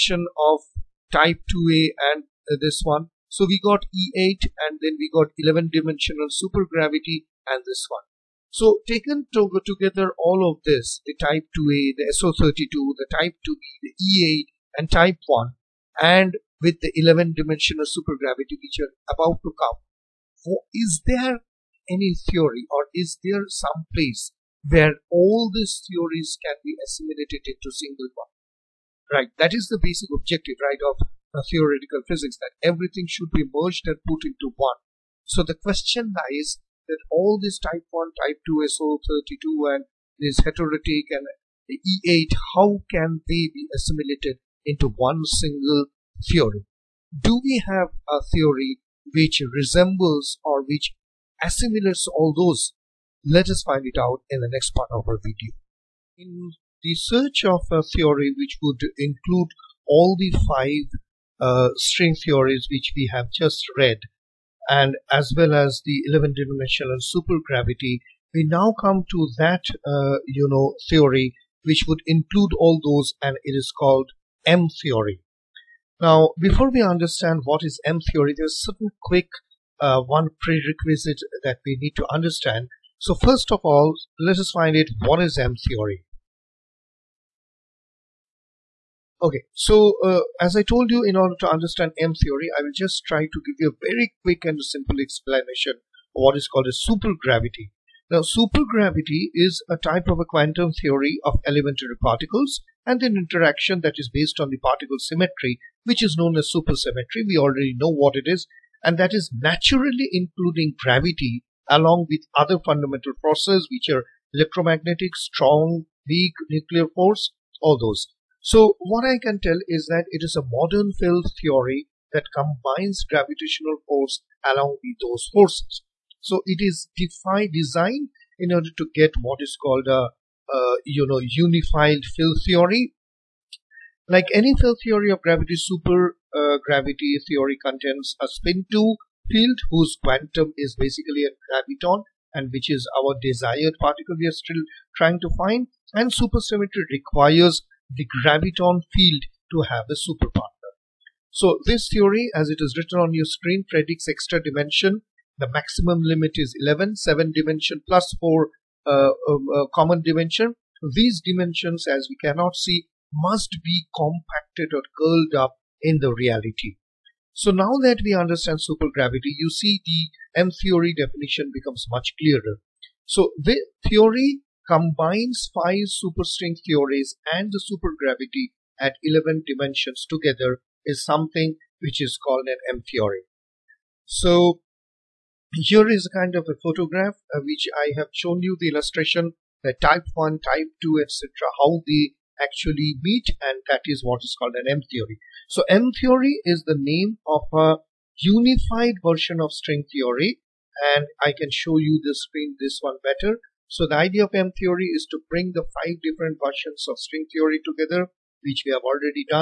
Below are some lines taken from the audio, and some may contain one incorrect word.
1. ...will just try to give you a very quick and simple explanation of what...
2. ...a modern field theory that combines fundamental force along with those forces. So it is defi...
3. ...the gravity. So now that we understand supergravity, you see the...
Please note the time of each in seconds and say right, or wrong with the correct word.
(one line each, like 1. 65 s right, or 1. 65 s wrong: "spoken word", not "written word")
1. 92 s right
2. 120 s wrong: "gravitational", not "fundamental"
3. 166 s wrong: "reality", not "gravity".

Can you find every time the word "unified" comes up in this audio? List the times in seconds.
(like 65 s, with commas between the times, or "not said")
131 s, 198 s.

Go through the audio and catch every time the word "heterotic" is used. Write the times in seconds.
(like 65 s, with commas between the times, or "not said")
40 s.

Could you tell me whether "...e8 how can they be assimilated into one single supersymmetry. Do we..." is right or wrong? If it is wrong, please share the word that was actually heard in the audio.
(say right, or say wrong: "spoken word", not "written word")
wrong: "theory", not "supersymmetry".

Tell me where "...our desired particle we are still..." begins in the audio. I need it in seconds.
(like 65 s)
142 s.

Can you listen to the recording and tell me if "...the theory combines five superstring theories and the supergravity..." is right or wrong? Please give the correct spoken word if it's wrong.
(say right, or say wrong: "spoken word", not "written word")
right.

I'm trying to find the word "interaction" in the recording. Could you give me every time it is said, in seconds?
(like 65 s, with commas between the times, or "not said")
103 s.